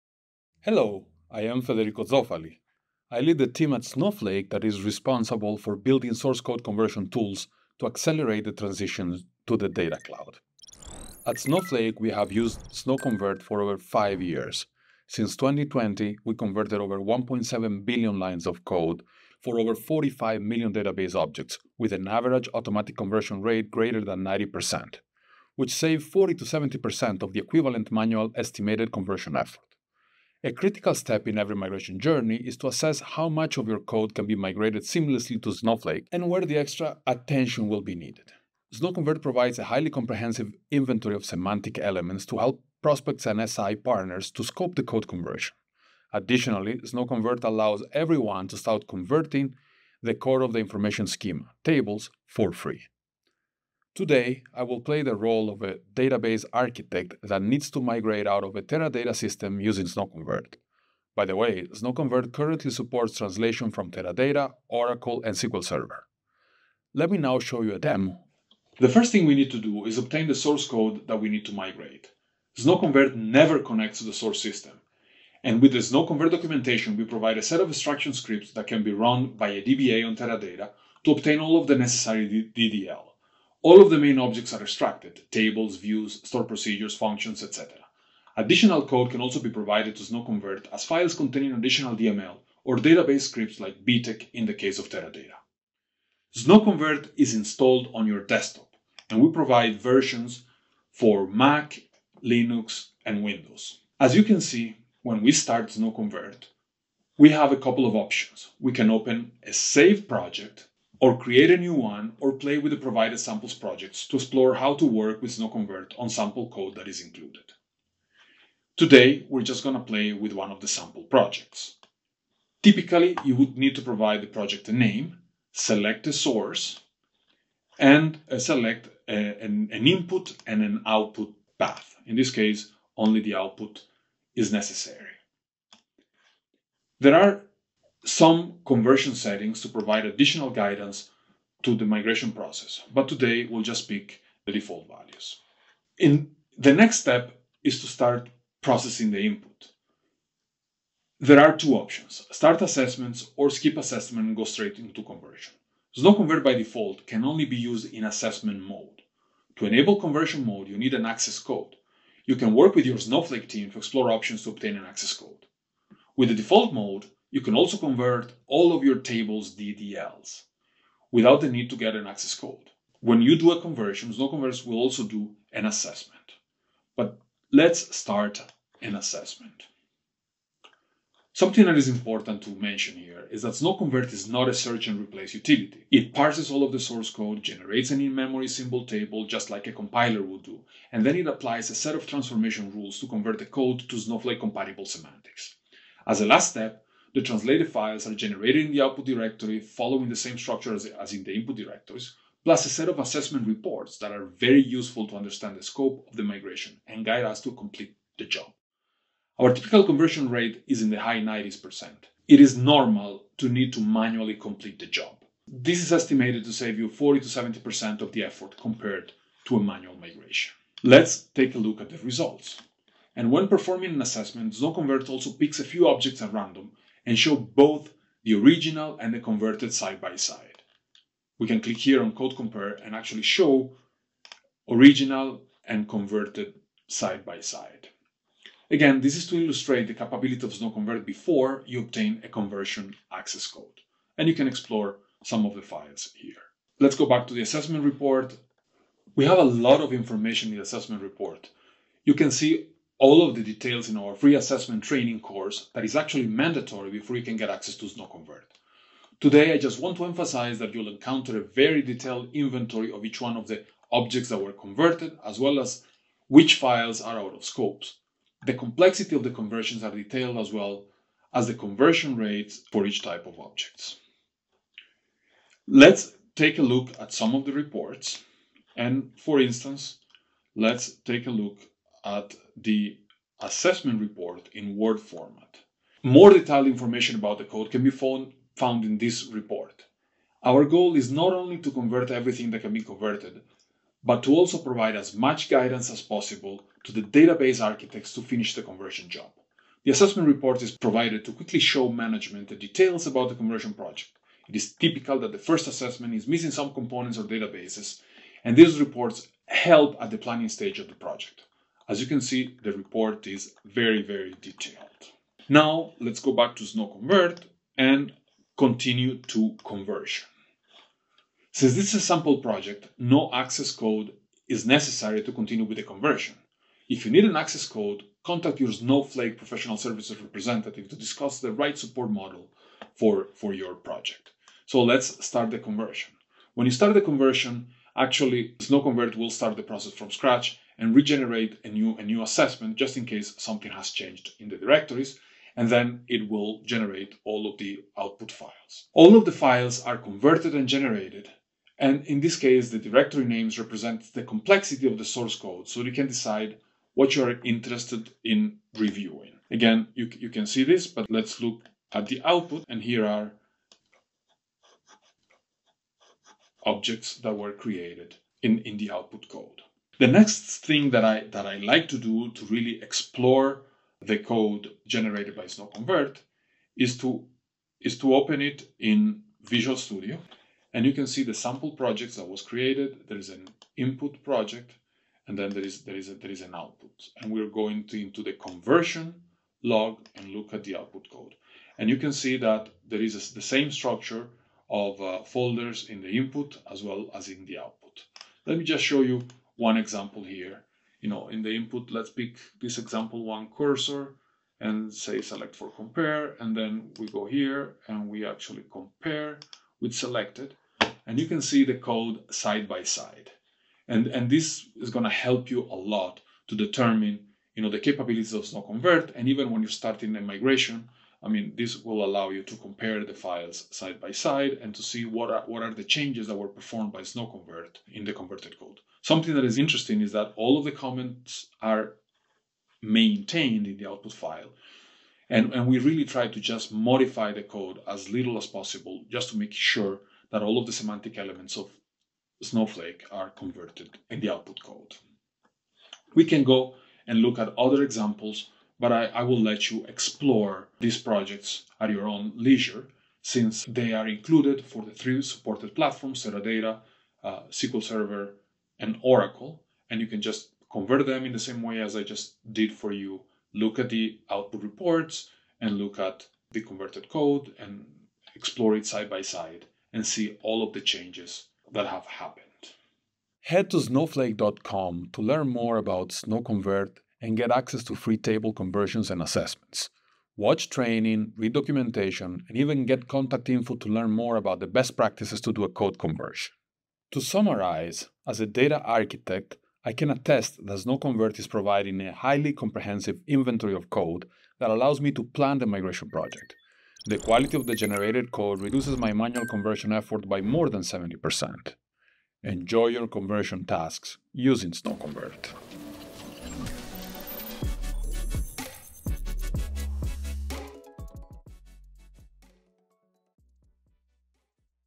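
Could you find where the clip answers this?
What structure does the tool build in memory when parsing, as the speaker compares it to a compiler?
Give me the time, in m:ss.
3:08.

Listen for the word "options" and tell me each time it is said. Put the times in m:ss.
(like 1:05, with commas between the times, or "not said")
1:47, 2:31, 2:44.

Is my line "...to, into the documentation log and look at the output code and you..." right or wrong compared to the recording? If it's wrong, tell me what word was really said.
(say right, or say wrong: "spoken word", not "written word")
wrong: "conversion", not "documentation".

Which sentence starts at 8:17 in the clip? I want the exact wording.
The quality of the generated code reduces my manual conversion effort by more than 70%.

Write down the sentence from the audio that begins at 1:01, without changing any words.
By the way, SnowConvert currently supports translation from Teradata, Oracle, and SQL Server.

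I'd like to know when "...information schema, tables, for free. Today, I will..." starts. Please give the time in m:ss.
0:50.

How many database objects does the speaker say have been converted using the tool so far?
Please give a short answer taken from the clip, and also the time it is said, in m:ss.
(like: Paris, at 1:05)
45 million, at 0:19.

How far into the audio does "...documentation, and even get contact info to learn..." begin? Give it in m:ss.
8:01.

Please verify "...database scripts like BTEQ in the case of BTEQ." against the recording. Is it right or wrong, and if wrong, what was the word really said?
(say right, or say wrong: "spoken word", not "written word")
wrong: "Teradata", not "BTEQ".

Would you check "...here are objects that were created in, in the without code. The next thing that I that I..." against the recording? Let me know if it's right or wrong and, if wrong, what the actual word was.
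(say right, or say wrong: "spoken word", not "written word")
wrong: "output", not "without".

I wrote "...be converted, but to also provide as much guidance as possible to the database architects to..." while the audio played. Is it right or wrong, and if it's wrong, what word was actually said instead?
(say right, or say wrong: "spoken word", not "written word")
right.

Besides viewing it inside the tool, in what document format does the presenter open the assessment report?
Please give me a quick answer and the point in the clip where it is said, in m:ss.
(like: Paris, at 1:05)
Word, at 4:44.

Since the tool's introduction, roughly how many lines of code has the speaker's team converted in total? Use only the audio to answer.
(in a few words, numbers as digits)
1.7 billion.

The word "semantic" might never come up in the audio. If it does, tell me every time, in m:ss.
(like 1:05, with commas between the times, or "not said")
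0:41, 3:14, 7:20.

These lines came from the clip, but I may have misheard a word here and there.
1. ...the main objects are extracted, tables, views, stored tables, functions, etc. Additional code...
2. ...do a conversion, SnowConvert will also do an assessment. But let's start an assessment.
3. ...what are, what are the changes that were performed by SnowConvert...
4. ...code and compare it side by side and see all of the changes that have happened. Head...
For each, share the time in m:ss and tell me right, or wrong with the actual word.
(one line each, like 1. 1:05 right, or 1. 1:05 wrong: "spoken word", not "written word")
1. 1:23 wrong: "procedures", not "tables"
2. 2:53 right
3. 7:05 right
4. 7:47 wrong: "explore", not "compare".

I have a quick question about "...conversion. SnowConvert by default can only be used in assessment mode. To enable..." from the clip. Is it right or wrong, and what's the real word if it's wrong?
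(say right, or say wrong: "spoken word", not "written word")
right.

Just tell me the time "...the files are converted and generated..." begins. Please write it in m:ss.
5:49.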